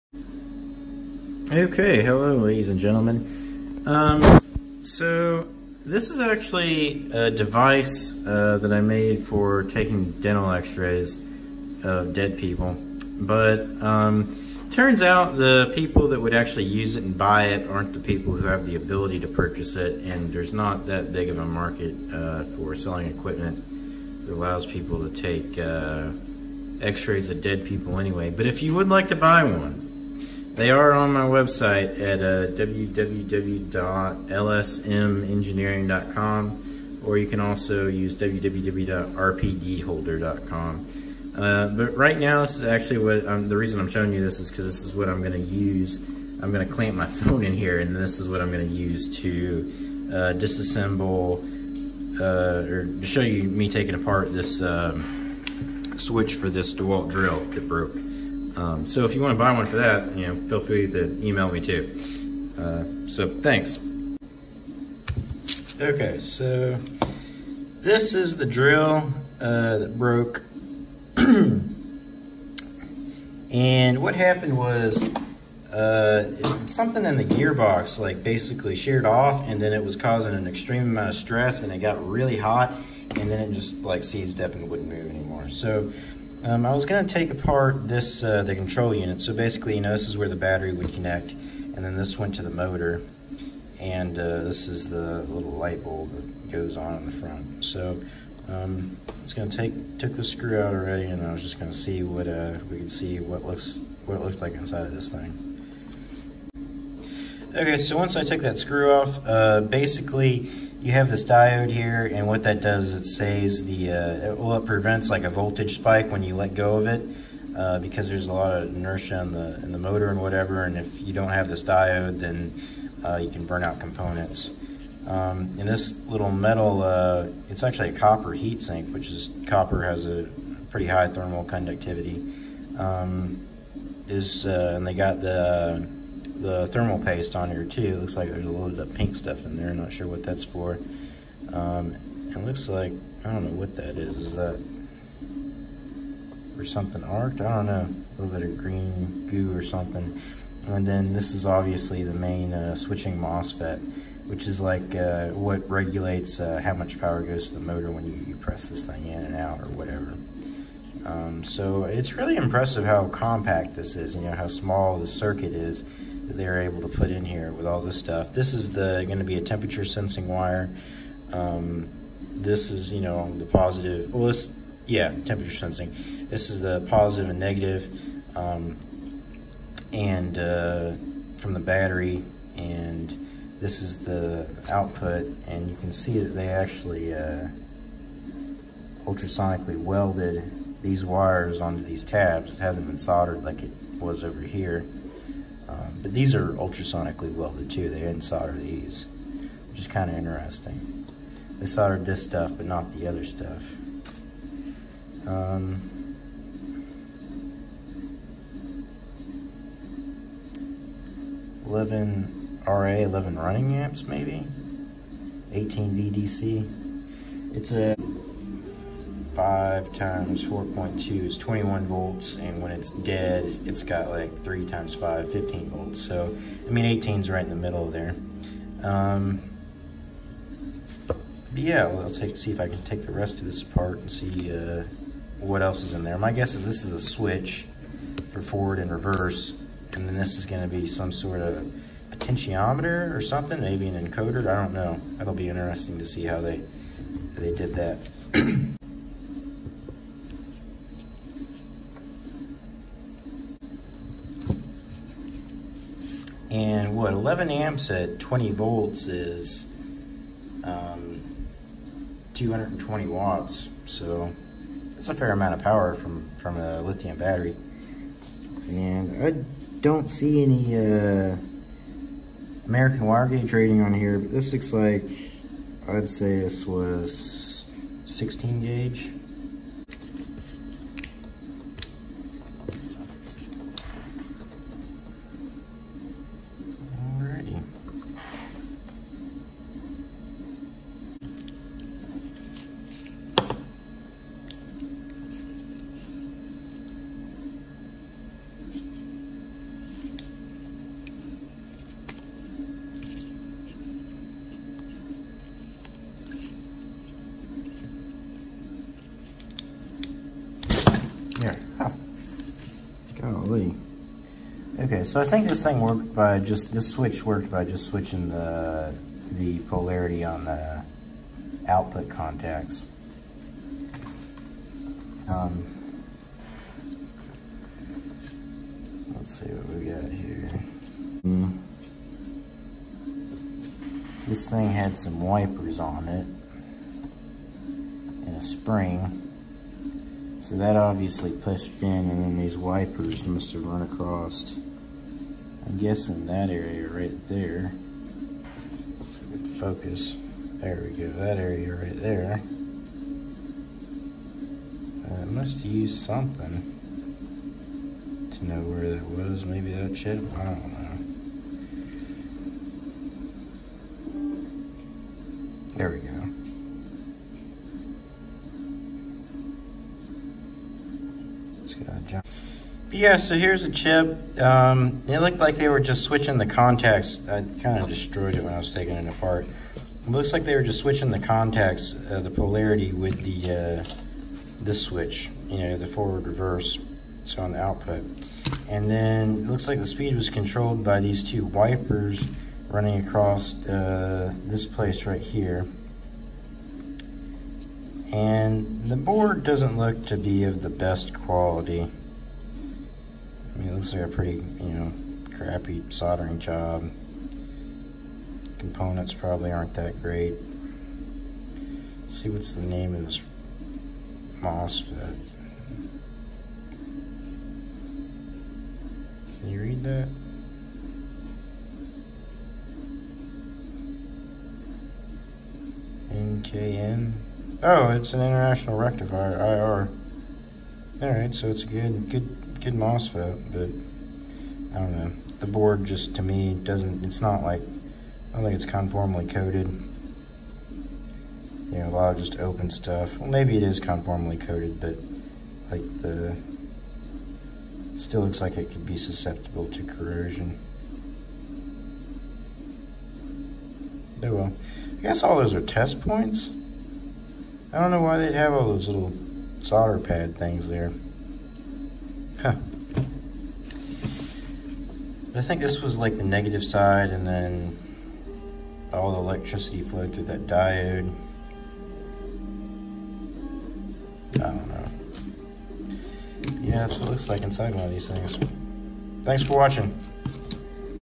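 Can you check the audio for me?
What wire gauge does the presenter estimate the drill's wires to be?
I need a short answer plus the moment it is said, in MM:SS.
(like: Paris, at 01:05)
16 gauge, at 04:38.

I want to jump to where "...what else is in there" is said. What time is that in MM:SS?
03:55.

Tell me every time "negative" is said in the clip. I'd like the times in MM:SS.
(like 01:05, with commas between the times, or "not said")
02:57, 07:46.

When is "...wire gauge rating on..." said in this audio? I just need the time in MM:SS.
04:33.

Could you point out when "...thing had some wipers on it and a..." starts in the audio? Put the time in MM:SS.
05:34.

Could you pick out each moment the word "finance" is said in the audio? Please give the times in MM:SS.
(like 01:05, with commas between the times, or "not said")
not said.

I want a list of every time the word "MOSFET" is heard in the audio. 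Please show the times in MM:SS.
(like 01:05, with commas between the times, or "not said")
02:33, 06:54, 07:12.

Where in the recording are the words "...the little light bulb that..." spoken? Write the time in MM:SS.
01:34.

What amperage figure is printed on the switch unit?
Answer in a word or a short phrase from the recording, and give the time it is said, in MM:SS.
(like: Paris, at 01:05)
11 amps, at 03:31.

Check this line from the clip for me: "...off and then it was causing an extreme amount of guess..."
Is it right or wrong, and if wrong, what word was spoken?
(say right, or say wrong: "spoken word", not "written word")
wrong: "stress", not "guess".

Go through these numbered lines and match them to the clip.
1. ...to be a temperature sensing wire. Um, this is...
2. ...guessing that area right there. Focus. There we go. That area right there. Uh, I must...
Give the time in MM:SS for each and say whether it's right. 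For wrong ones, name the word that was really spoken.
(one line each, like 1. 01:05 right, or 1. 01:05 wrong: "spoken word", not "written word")
1. 02:49 right
2. 05:45 right.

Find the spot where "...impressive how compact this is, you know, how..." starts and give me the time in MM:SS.
02:42.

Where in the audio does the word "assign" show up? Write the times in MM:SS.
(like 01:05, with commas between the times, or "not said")
not said.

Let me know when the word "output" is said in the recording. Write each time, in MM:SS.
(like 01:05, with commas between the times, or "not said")
03:04, 05:21, 06:27.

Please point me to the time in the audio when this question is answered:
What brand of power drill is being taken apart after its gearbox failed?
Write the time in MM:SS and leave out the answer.
00:56.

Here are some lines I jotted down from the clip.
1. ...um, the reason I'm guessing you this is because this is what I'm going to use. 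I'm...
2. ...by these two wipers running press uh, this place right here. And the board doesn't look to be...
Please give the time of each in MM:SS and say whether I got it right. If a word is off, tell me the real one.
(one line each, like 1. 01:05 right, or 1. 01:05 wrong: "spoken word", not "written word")
1. 00:43 wrong: "showing", not "guessing"
2. 06:30 wrong: "across", not "press".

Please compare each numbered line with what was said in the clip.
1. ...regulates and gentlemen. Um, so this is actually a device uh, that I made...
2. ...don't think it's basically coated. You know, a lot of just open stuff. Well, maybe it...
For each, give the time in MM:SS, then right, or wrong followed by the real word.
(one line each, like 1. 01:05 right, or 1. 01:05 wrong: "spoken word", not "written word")
1. 00:02 wrong: "ladies", not "regulates"
2. 07:18 wrong: "conformally", not "basically".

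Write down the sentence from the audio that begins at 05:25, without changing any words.
Um, let's see what we got here.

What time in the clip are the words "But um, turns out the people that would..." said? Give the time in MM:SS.
00:13.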